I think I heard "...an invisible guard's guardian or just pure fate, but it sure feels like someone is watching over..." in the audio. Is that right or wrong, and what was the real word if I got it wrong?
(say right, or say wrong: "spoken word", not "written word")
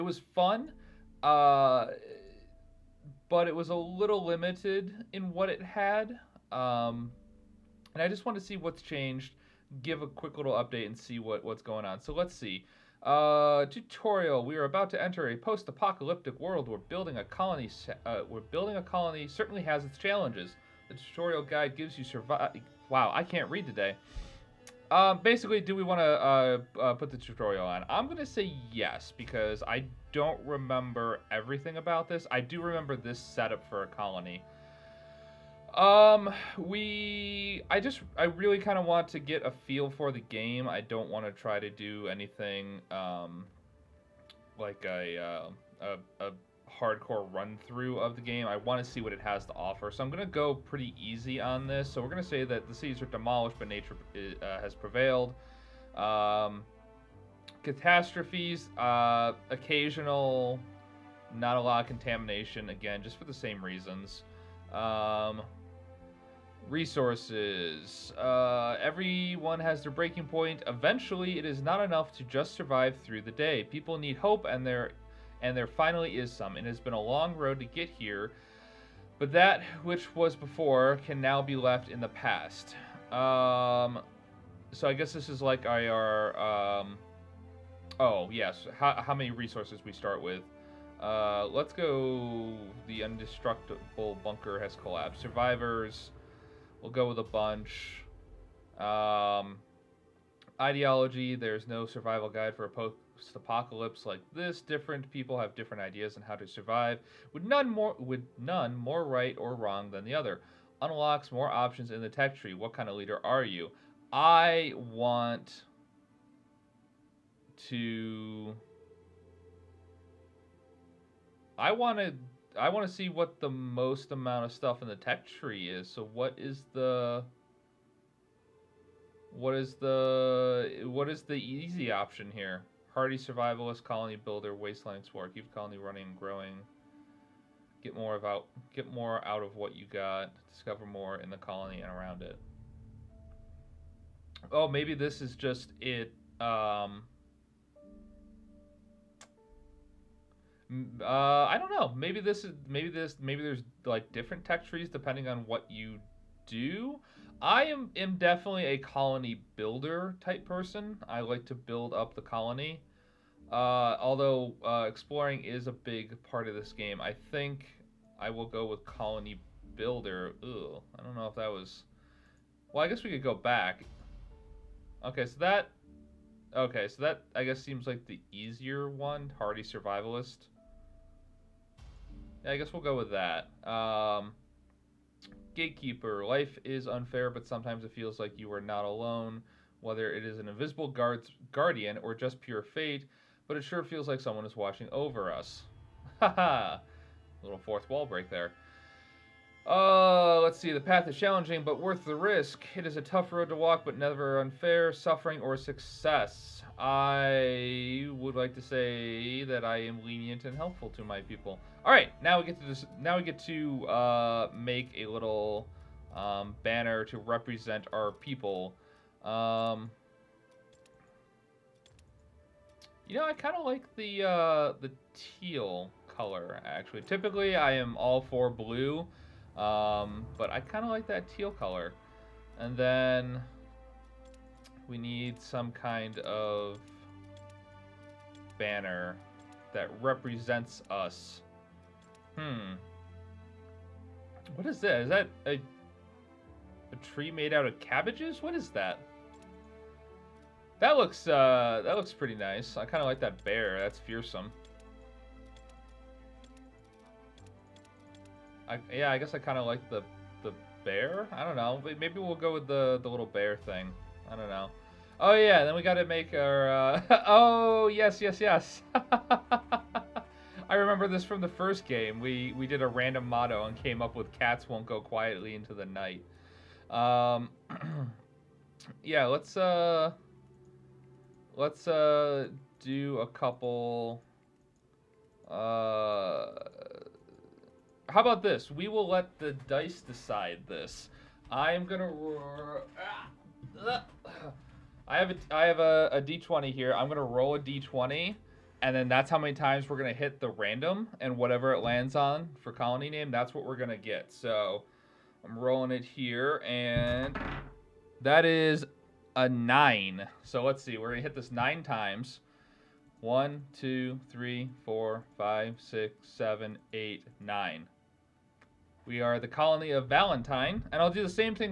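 right.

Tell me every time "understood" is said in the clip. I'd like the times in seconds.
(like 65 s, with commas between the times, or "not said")
not said.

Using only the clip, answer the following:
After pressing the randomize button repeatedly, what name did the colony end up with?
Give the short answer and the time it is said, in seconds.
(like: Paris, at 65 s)
Valentine, at 320 s.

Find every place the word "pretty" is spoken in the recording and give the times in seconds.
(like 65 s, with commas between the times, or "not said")
50 s, 252 s.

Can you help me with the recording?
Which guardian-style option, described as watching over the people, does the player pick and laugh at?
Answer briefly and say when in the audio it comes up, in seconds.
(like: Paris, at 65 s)
Gatekeeper, at 185 s.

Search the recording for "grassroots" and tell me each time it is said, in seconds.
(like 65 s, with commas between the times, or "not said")
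not said.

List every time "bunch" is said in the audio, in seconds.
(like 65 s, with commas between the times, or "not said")
97 s.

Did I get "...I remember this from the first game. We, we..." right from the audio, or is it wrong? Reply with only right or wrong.
right.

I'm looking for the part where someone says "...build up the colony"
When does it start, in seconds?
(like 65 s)
161 s.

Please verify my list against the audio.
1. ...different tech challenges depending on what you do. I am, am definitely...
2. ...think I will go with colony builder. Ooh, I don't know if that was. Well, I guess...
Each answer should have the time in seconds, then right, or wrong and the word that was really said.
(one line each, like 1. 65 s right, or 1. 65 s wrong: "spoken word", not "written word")
1. 154 s wrong: "trees", not "challenges"
2. 167 s right.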